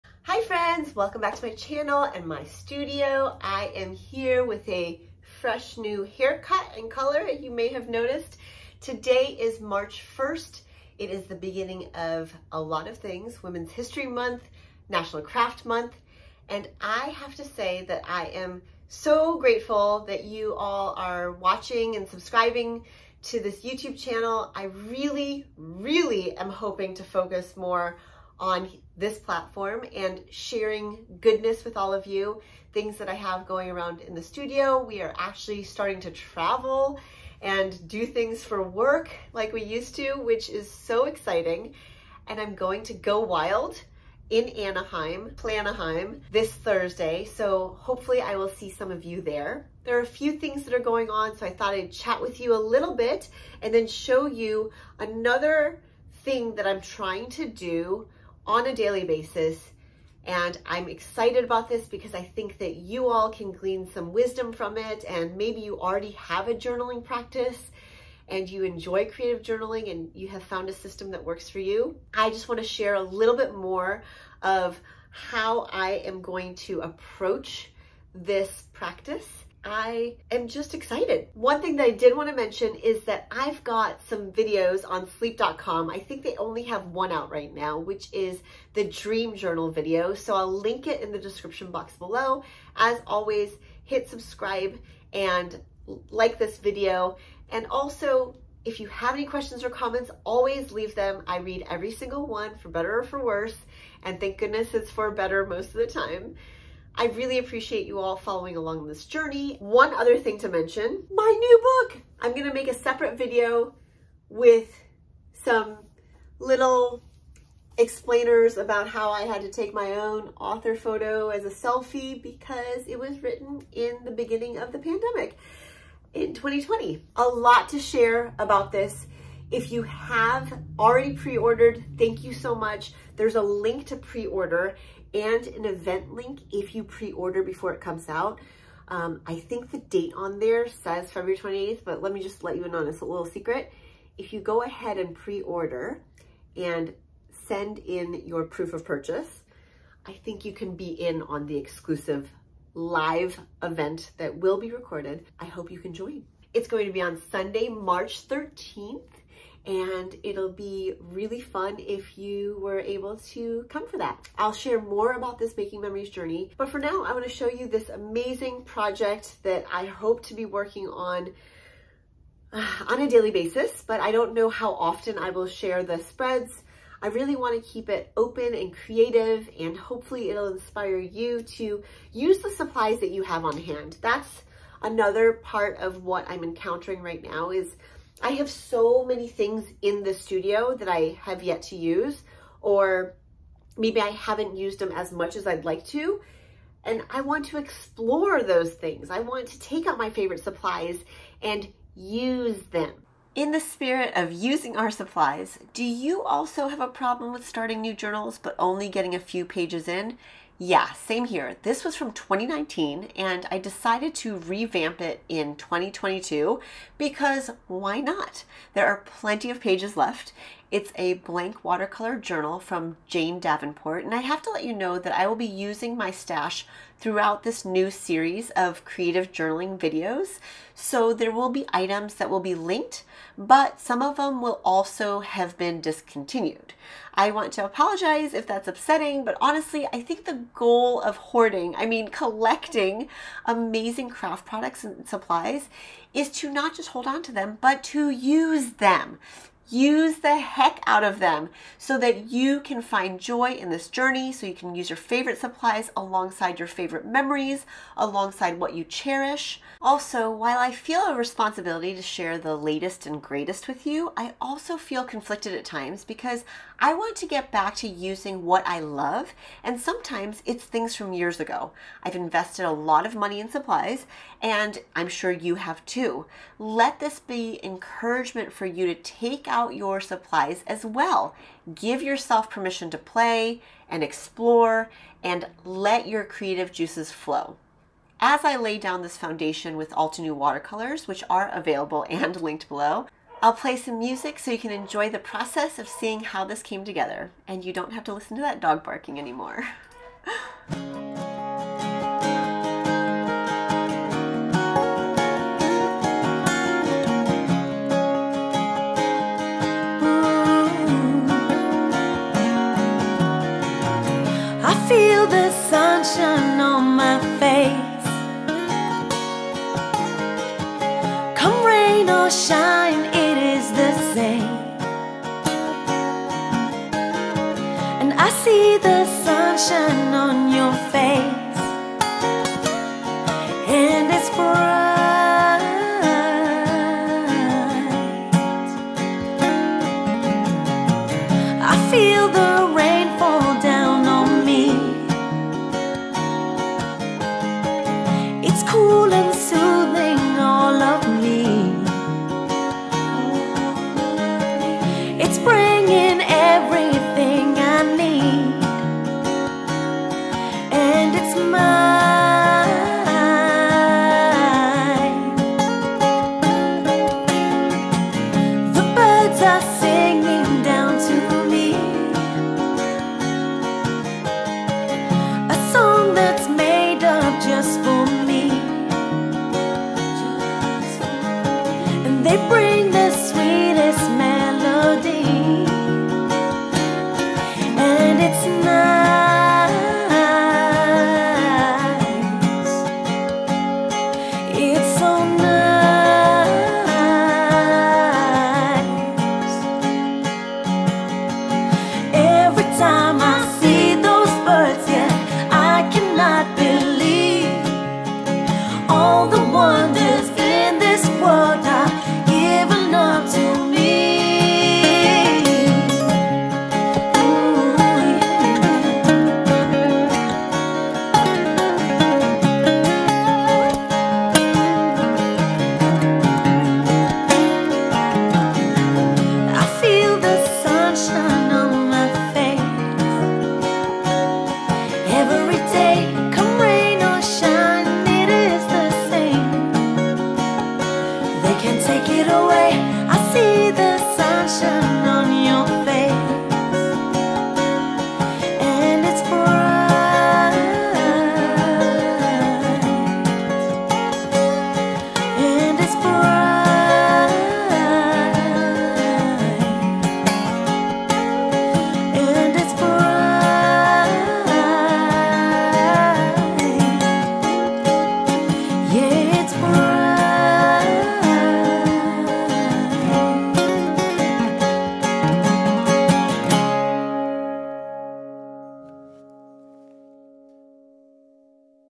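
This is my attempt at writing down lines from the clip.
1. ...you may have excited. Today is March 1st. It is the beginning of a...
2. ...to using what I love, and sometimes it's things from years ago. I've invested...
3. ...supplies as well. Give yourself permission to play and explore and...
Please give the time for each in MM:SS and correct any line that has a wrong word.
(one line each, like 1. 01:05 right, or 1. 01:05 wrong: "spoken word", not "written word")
1. 00:07 wrong: "noticed", not "excited"
2. 04:27 right
3. 04:39 right.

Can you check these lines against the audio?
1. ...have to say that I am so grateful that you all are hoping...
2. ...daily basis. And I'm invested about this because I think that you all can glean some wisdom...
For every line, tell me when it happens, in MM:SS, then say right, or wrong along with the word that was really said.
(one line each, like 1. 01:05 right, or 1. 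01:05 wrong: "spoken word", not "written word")
1. 00:17 wrong: "watching", not "hoping"
2. 00:58 wrong: "excited", not "invested".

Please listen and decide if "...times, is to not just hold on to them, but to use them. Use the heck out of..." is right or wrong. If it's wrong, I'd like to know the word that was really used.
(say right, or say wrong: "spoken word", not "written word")
wrong: "supplies", not "times".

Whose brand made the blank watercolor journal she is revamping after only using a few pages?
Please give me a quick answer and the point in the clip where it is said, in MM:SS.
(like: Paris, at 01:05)
Jane Davenport, at 03:43.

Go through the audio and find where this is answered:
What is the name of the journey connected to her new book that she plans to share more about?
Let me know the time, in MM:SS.
02:45.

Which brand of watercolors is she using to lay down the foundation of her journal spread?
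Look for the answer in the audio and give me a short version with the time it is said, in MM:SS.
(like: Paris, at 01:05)
Altenew, at 04:49.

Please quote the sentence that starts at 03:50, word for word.
So there will be items that will be linked, but some of them will also have been discontinued.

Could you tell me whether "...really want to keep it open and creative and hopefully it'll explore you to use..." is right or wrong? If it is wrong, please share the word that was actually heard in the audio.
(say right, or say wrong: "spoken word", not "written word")
wrong: "inspire", not "explore".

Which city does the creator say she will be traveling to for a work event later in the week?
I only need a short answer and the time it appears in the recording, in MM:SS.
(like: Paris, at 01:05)
Anaheim, at 00:44.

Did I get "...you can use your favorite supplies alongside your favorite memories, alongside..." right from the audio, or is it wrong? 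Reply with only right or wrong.
right.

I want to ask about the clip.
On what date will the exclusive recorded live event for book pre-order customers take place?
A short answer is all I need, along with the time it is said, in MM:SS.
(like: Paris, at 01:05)
Sunday, March 13th, at 02:37.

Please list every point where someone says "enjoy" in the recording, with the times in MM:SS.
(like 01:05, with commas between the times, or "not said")
01:08, 04:54.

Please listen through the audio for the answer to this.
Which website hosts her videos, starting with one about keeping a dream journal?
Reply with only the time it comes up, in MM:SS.
01:25.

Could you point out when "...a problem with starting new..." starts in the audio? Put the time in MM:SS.
03:26.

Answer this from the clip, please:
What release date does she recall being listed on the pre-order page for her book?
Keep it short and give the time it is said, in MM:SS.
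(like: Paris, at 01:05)
February 28th, at 02:21.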